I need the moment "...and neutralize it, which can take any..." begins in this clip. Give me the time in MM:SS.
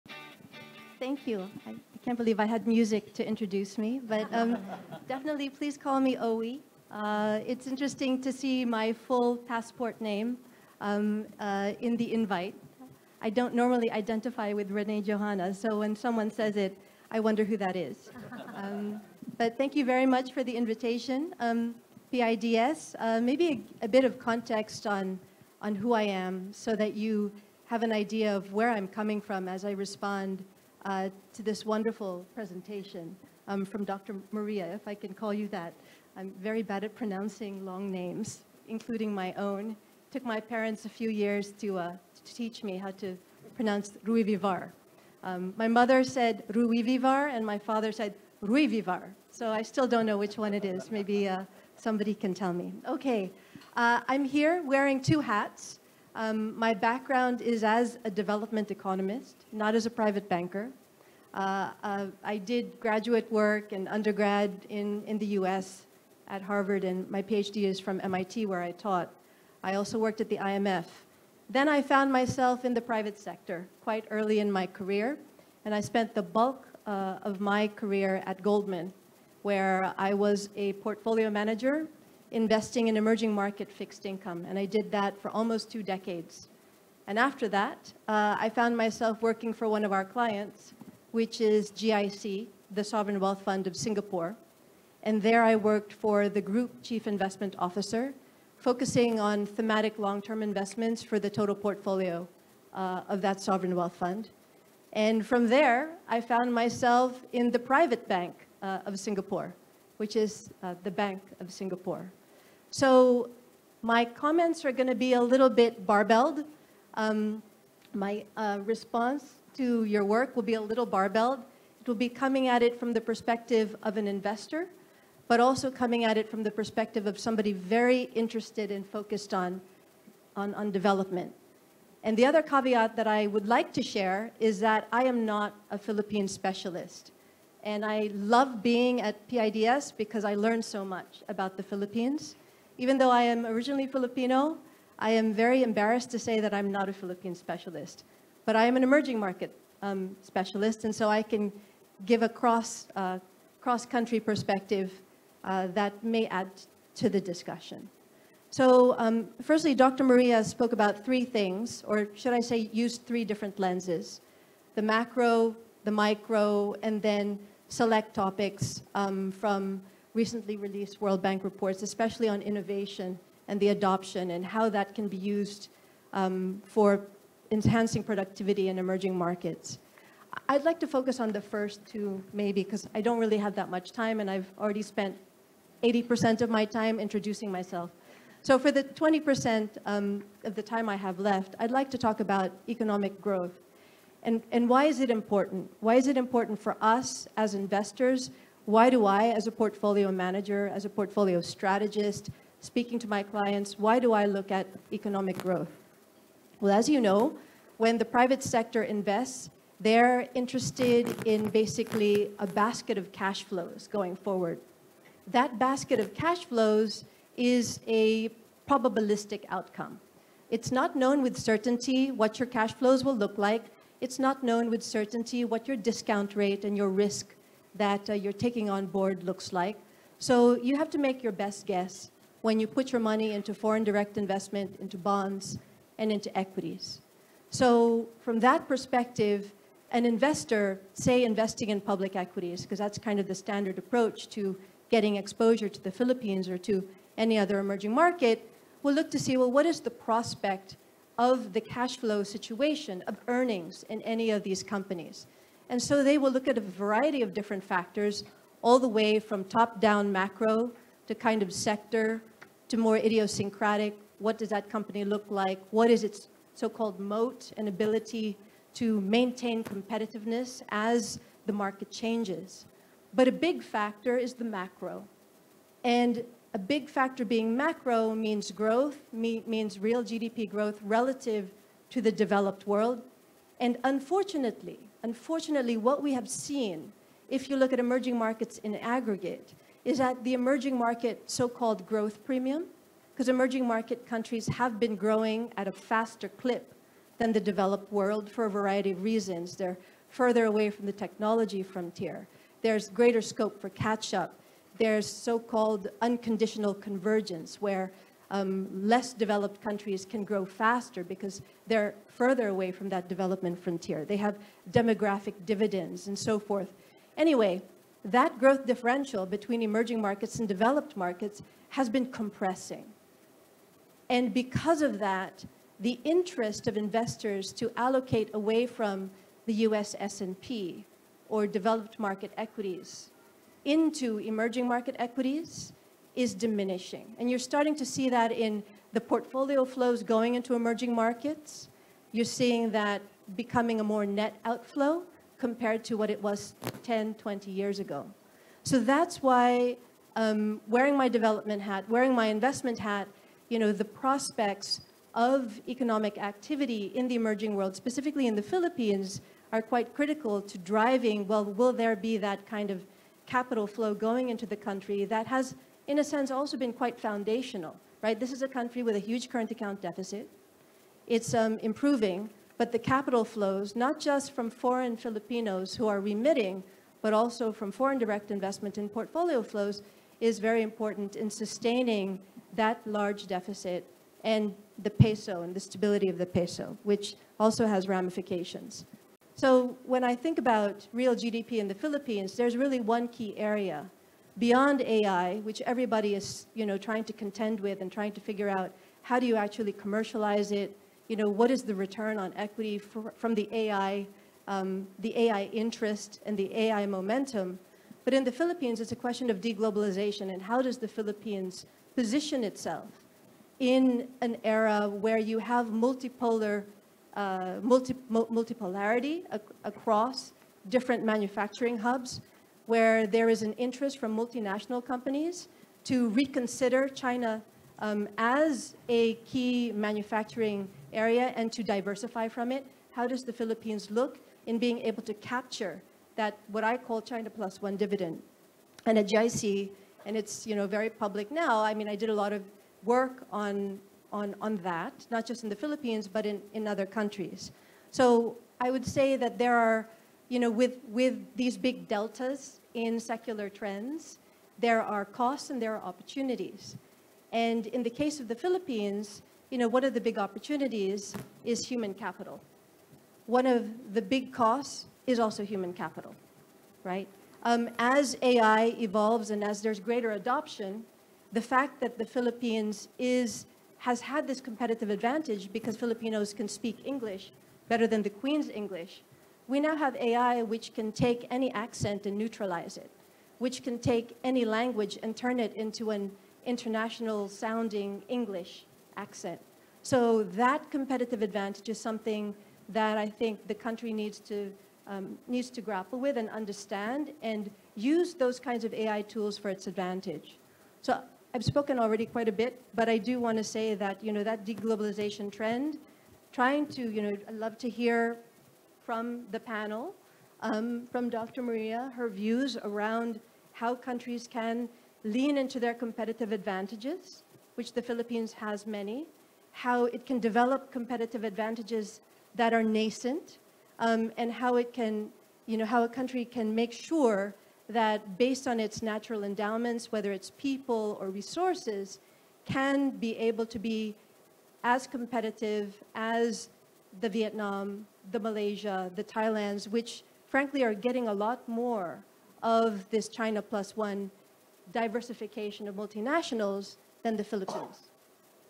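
08:02.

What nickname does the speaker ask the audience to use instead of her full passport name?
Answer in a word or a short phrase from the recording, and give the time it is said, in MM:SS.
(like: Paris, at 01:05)
Owe, at 00:06.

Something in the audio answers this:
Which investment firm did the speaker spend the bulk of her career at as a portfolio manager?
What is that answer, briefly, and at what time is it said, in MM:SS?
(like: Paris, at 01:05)
Goldman, at 01:18.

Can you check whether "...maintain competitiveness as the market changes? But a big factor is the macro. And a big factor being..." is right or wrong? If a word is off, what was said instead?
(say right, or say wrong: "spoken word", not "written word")
right.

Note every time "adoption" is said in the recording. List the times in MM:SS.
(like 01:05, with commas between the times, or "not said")
02:53, 07:50.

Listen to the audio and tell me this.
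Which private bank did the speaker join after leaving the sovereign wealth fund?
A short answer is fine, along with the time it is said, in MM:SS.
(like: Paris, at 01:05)
Bank of Singapore, at 01:50.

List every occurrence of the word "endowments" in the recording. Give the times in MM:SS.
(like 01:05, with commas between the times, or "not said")
08:49.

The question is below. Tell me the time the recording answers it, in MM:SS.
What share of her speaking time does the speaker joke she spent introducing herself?
03:05.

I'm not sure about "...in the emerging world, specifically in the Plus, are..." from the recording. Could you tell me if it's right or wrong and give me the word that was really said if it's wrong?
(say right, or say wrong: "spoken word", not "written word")
wrong: "Philippines", not "Plus".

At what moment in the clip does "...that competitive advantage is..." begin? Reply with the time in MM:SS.
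08:10.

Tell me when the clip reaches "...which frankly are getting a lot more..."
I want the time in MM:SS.
08:59.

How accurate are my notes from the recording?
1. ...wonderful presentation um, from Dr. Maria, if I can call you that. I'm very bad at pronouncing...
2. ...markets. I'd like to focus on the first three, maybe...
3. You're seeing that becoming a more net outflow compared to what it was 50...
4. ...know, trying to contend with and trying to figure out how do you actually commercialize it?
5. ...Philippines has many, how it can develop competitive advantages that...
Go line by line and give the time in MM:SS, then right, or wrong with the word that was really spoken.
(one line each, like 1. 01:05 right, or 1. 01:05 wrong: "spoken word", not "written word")
1. 00:31 right
2. 02:59 wrong: "two", not "three"
3. 05:42 wrong: "10", not "50"
4. 06:36 right
5. 08:37 right.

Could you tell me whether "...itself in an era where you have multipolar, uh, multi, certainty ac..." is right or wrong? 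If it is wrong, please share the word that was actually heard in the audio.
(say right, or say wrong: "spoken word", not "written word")
wrong: "multipolarity", not "certainty".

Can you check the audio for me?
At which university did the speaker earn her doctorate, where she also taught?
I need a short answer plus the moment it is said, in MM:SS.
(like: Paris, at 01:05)
MIT, at 01:08.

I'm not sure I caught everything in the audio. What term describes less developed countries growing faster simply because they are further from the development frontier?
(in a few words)
unconditional convergence.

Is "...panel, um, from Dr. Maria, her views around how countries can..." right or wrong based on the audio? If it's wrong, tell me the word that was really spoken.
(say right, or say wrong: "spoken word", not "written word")
right.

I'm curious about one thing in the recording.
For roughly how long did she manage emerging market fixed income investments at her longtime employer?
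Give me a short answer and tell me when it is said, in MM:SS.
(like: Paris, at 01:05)
almost two decades, at 01:25.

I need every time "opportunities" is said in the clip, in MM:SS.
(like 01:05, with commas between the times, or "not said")
07:35, 07:40.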